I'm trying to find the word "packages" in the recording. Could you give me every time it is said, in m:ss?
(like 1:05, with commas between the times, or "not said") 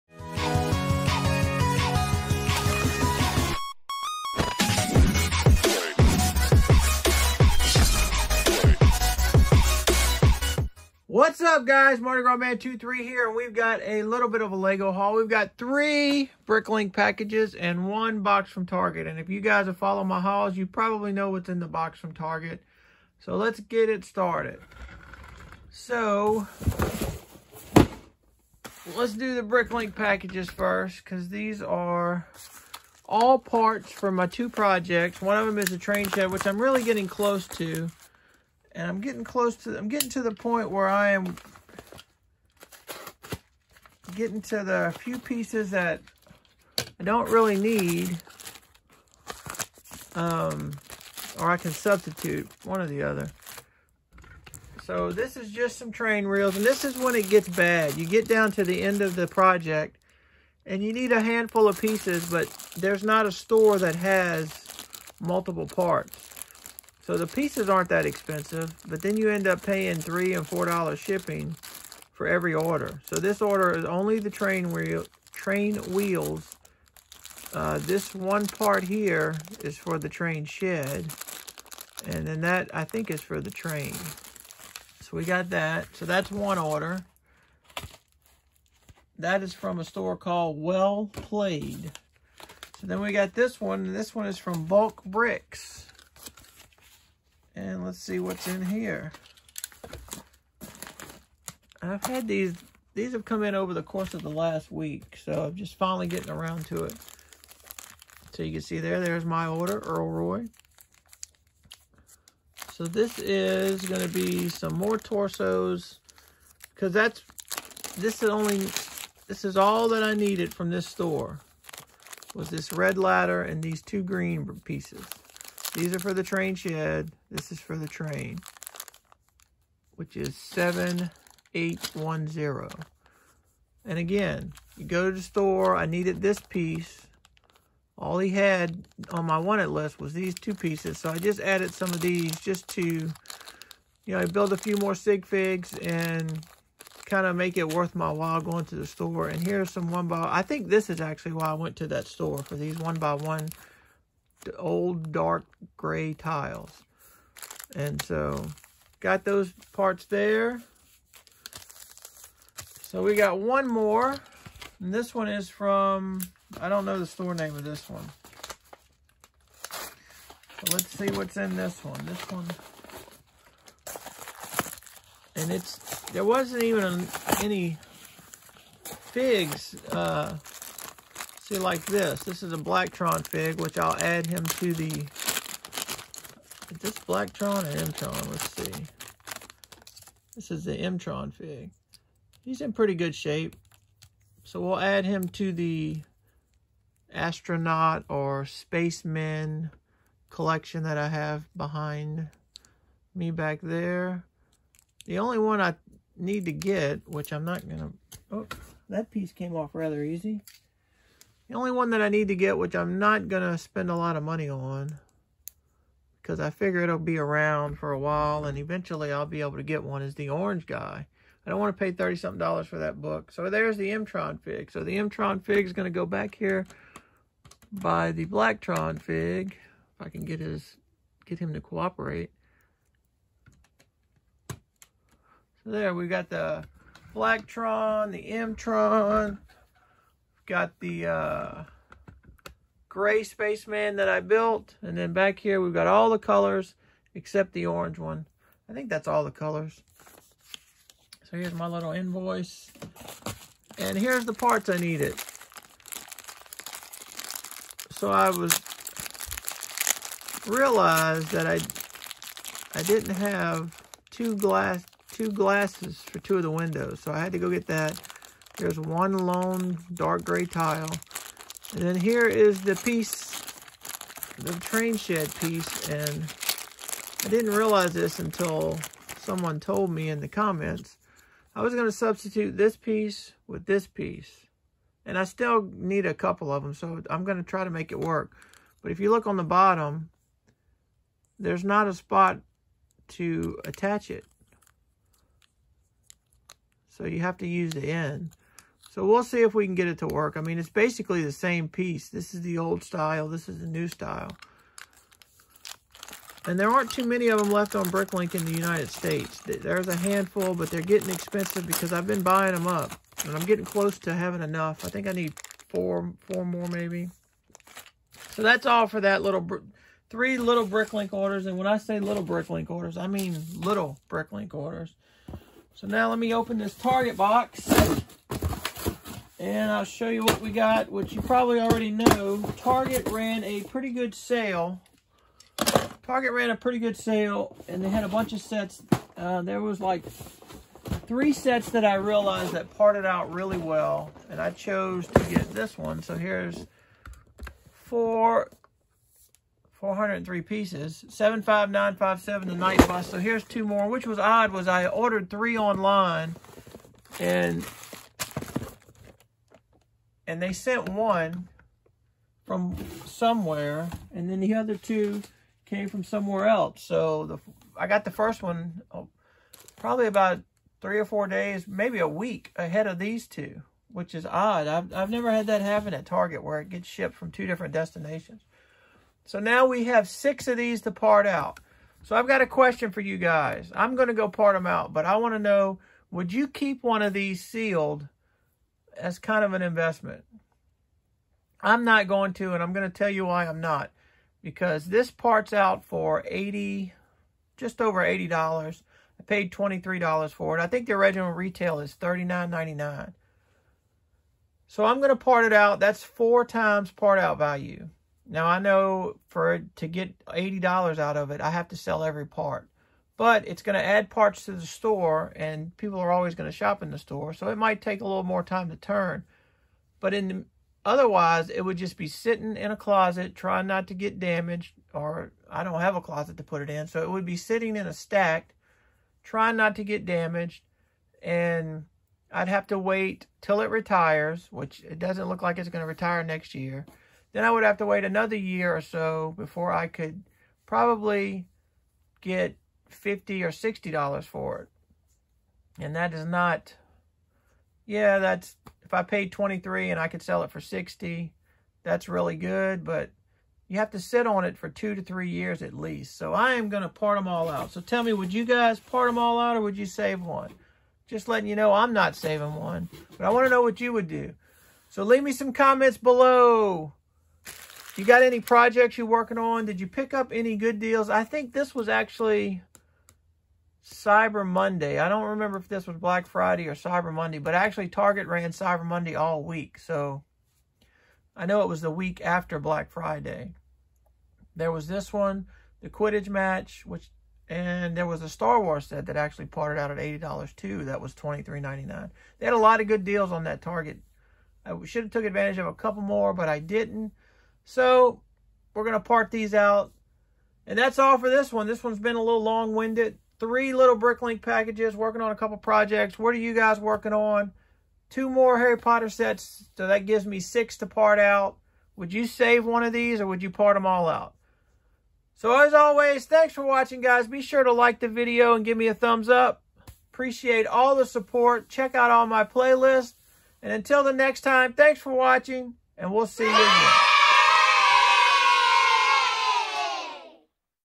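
0:16, 0:29, 8:24.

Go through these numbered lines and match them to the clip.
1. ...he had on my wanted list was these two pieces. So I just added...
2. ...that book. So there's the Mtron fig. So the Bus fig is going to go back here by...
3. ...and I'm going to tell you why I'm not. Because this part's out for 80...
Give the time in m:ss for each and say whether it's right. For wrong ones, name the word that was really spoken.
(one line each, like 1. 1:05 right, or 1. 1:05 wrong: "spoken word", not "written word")
1. 2:18 right
2. 3:42 wrong: "Mtron", not "Bus"
3. 6:32 right.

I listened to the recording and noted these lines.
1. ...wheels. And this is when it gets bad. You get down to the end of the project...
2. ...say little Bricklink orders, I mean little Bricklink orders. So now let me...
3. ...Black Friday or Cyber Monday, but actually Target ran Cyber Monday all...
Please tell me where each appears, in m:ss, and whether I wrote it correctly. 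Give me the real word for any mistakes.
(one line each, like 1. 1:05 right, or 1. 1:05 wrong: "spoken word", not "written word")
1. 0:56 right
2. 5:21 right
3. 7:55 right.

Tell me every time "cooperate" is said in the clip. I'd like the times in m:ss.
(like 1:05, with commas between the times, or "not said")
3:51.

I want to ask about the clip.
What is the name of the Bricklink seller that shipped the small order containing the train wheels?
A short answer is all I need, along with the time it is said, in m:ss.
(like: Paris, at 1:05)
Well Played, at 1:30.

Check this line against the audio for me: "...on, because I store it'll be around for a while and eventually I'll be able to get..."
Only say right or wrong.
wrong.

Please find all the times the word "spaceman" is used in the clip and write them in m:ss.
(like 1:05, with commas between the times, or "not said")
3:18, 4:03.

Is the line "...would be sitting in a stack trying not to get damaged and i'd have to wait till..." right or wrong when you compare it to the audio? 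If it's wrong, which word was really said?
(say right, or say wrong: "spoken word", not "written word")
right.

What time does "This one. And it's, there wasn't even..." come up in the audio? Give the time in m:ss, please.
2:52.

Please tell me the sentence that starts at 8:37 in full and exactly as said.
Be sure to like the video and give me a thumbs up.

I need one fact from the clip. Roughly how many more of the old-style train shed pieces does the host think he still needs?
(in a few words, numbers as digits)
4.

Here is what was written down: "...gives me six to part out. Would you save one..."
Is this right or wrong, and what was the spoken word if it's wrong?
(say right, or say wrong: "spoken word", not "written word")
right.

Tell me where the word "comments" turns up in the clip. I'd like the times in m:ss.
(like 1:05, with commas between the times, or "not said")
4:40, 7:45.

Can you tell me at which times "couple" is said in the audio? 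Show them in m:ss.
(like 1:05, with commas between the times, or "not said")
4:46, 8:15, 8:25.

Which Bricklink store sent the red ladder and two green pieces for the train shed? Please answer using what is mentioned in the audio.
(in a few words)
Bulk Bricks.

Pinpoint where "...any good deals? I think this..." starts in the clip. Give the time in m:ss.
7:50.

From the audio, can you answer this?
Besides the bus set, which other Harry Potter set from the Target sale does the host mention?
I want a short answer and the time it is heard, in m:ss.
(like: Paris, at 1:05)
The Quidditch match, at 8:05.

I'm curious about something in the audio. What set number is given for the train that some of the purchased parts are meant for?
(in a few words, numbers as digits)
7810.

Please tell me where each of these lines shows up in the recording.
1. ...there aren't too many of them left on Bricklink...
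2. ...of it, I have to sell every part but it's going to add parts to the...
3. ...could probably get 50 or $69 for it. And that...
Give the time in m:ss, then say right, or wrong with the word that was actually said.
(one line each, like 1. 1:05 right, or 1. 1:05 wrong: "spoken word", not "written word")
1. 5:06 right
2. 6:51 right
3. 7:19 wrong: "60", not "69".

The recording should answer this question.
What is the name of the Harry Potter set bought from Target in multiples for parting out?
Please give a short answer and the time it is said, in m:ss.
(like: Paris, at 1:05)
The Knight Bus, at 5:52.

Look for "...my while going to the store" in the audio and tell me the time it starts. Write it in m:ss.
2:27.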